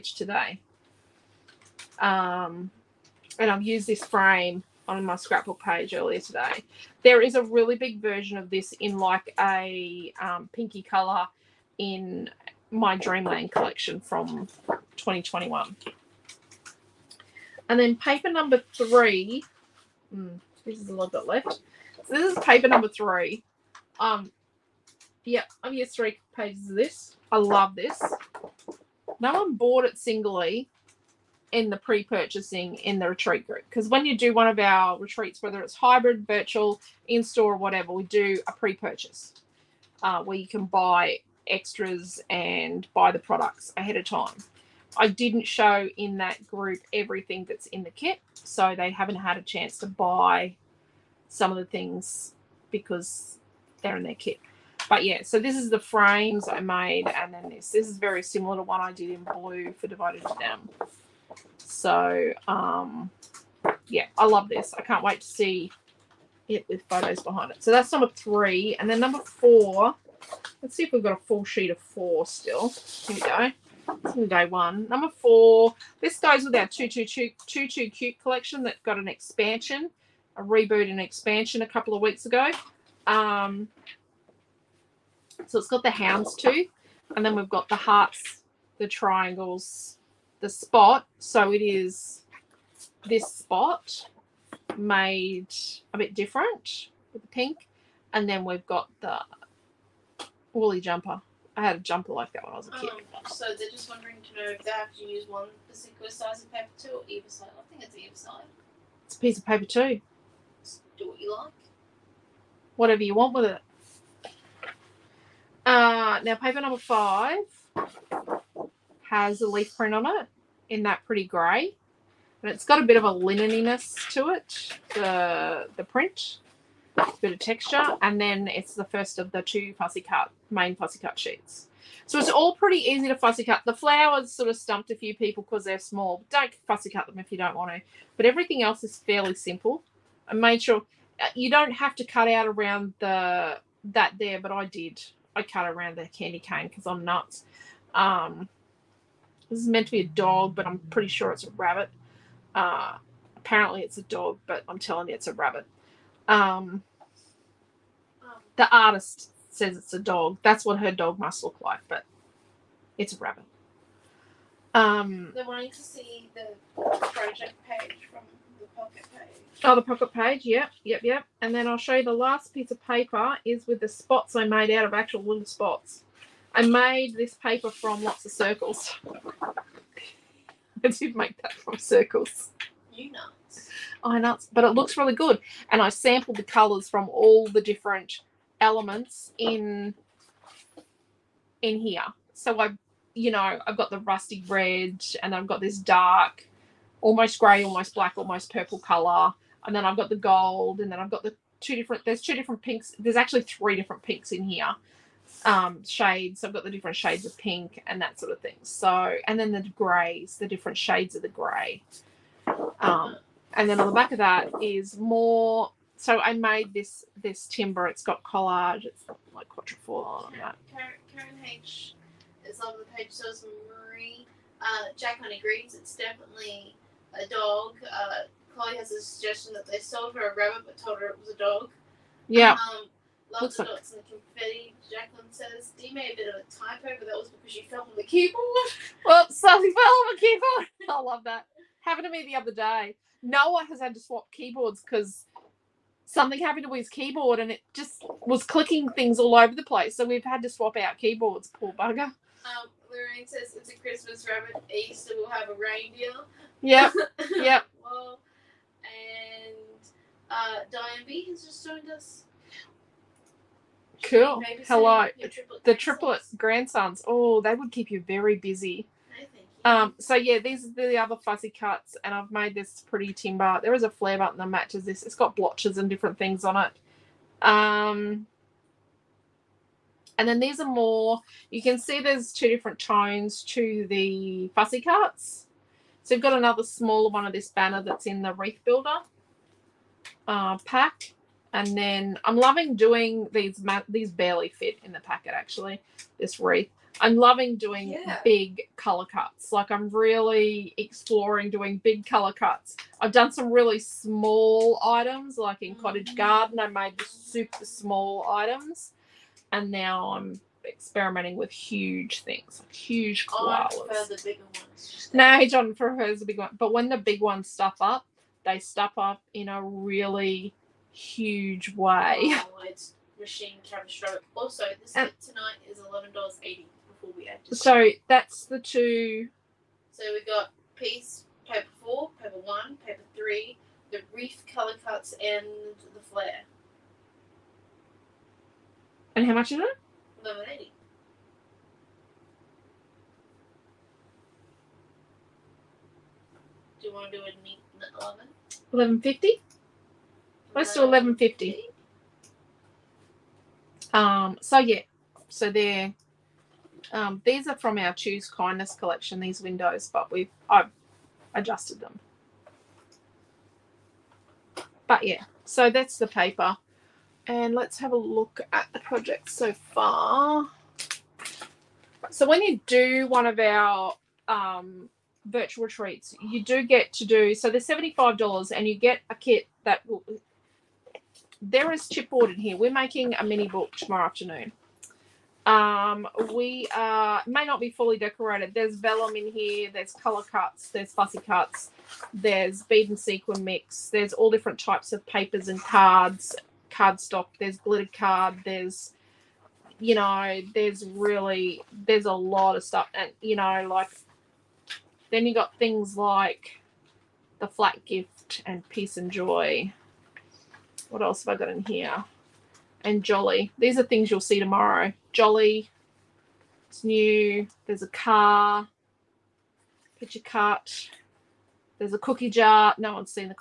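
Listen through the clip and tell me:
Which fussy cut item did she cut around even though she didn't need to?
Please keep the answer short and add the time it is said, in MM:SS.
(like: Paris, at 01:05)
candy cane, at 02:26.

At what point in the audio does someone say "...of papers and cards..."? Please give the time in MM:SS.
06:34.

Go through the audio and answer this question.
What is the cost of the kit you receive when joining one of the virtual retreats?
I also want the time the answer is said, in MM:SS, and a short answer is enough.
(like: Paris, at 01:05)
$75, at 06:17.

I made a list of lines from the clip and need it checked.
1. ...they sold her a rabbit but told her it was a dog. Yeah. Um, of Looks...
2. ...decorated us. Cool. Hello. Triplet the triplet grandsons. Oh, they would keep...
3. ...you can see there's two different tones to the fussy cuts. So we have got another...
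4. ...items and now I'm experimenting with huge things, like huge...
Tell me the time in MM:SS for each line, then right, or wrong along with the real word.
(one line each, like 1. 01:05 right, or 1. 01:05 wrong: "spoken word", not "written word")
1. 03:49 right
2. 04:21 wrong: "joined", not "decorated"
3. 04:41 right
4. 05:08 right.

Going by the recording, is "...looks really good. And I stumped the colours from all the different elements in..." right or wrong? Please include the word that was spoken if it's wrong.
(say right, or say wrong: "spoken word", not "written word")
wrong: "sampled", not "stumped".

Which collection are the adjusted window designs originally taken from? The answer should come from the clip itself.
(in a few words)
Choose Kindness.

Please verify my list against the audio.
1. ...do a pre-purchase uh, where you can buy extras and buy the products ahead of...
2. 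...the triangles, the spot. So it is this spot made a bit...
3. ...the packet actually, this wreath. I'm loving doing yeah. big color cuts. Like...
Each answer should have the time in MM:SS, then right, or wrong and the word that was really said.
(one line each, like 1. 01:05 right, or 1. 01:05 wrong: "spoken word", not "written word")
1. 00:38 right
2. 01:28 right
3. 04:54 right.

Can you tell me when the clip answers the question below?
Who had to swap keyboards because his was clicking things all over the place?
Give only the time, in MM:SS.
04:03.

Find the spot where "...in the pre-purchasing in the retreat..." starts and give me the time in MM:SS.
00:31.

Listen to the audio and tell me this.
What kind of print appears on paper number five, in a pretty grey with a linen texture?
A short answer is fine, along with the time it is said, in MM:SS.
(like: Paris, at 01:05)
leaf print, at 01:59.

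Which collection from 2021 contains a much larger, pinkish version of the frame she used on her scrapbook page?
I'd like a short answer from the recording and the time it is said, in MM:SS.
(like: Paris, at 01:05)
Dreamland, at 00:12.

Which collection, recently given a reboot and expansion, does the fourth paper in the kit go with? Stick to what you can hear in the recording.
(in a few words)
222 Cute.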